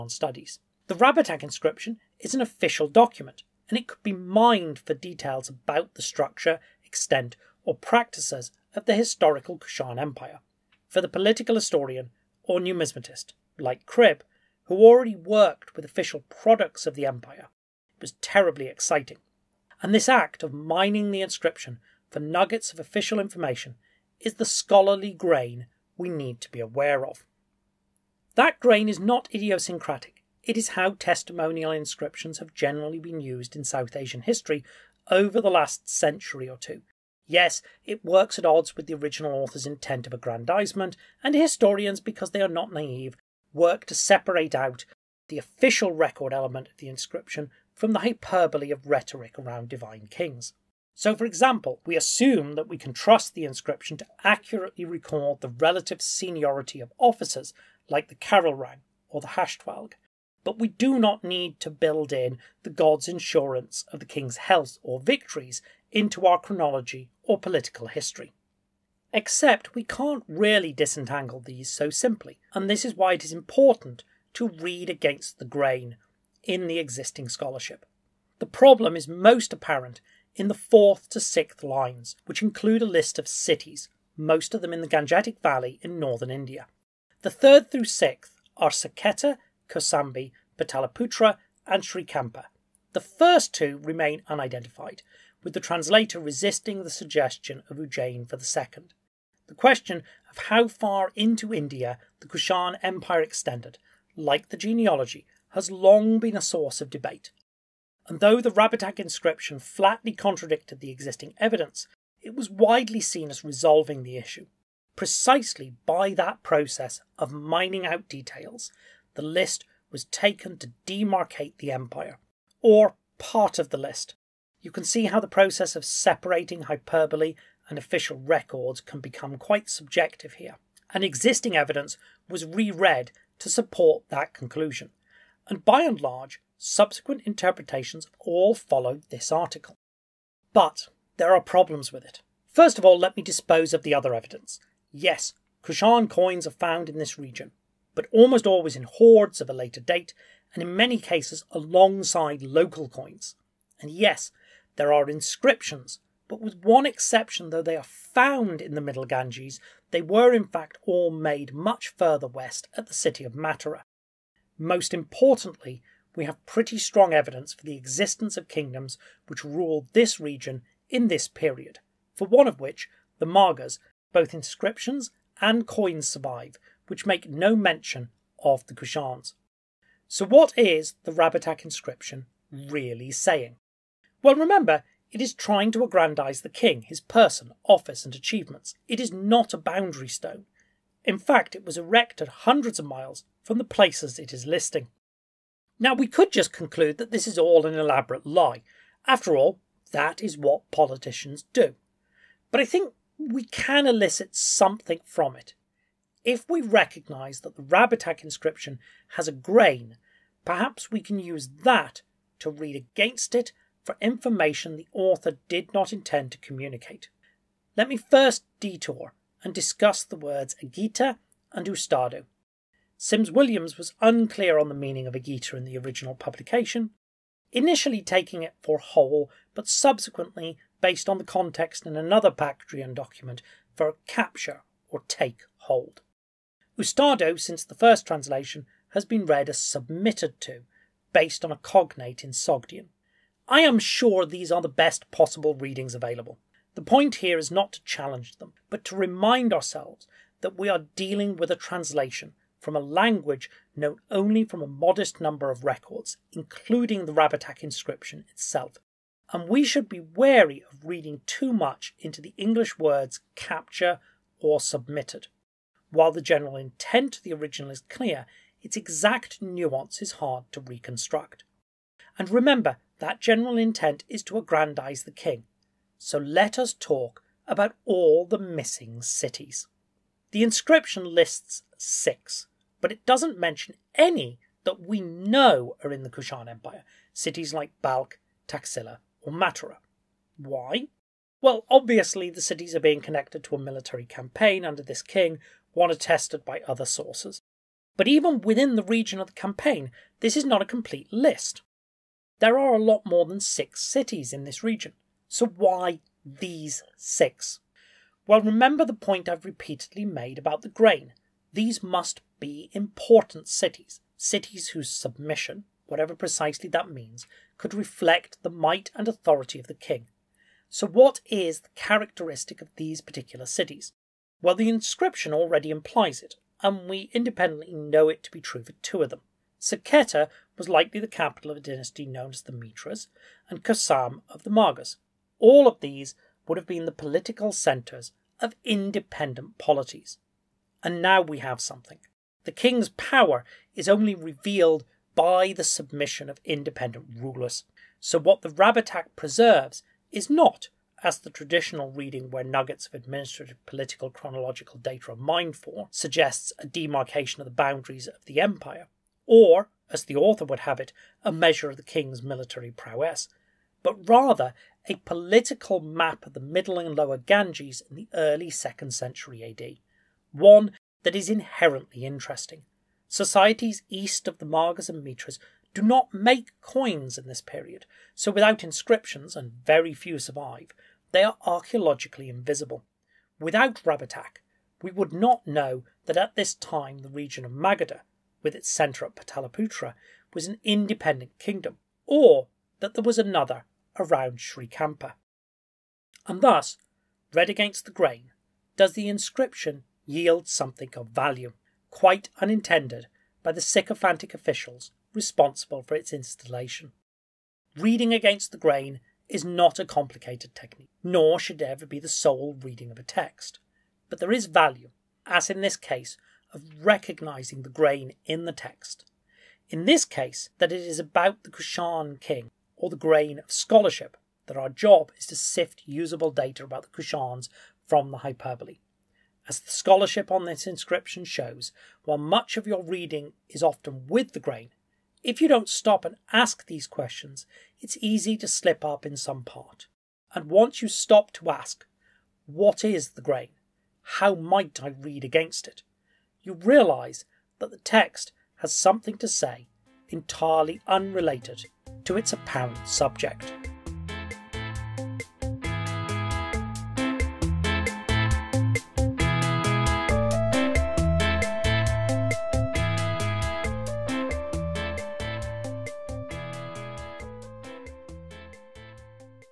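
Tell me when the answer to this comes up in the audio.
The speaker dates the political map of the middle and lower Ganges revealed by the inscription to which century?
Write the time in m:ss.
6:08.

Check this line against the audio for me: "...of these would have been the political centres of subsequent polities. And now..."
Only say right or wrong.
wrong.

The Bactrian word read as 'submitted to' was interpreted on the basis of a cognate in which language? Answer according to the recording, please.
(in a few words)
Sogdian.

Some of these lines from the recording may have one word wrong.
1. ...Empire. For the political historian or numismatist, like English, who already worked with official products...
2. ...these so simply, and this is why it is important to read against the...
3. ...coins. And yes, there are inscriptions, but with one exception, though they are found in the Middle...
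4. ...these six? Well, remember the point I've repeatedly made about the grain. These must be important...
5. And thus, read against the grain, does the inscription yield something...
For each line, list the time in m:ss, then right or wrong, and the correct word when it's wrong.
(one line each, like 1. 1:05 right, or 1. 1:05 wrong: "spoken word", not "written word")
1. 0:09 wrong: "Cribb", not "English"
2. 1:11 right
3. 2:32 right
4. 5:06 right
5. 6:36 right.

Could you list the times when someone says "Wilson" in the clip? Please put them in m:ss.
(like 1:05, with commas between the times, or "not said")
not said.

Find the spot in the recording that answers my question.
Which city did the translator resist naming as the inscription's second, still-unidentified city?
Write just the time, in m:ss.
1:37.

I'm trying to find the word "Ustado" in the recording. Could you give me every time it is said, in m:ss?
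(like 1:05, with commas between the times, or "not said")
3:41, 3:56.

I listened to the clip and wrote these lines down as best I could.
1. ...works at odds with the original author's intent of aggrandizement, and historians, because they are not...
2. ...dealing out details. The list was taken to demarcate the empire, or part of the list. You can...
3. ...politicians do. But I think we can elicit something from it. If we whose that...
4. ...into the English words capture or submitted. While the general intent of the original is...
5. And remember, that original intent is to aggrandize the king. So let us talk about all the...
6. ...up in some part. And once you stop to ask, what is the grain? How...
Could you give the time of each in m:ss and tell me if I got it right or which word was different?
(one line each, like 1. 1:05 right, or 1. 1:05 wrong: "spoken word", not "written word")
1. 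0:38 right
2. 1:57 wrong: "mining", not "dealing"
3. 3:20 wrong: "recognise", not "whose"
4. 4:21 right
5. 4:32 wrong: "general", not "original"
6. 7:18 right.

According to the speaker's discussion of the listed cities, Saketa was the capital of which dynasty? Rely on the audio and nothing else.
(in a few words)
The Mitras.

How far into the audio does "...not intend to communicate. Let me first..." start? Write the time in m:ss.
3:35.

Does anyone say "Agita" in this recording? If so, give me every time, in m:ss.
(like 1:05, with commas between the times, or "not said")
3:40, 3:45.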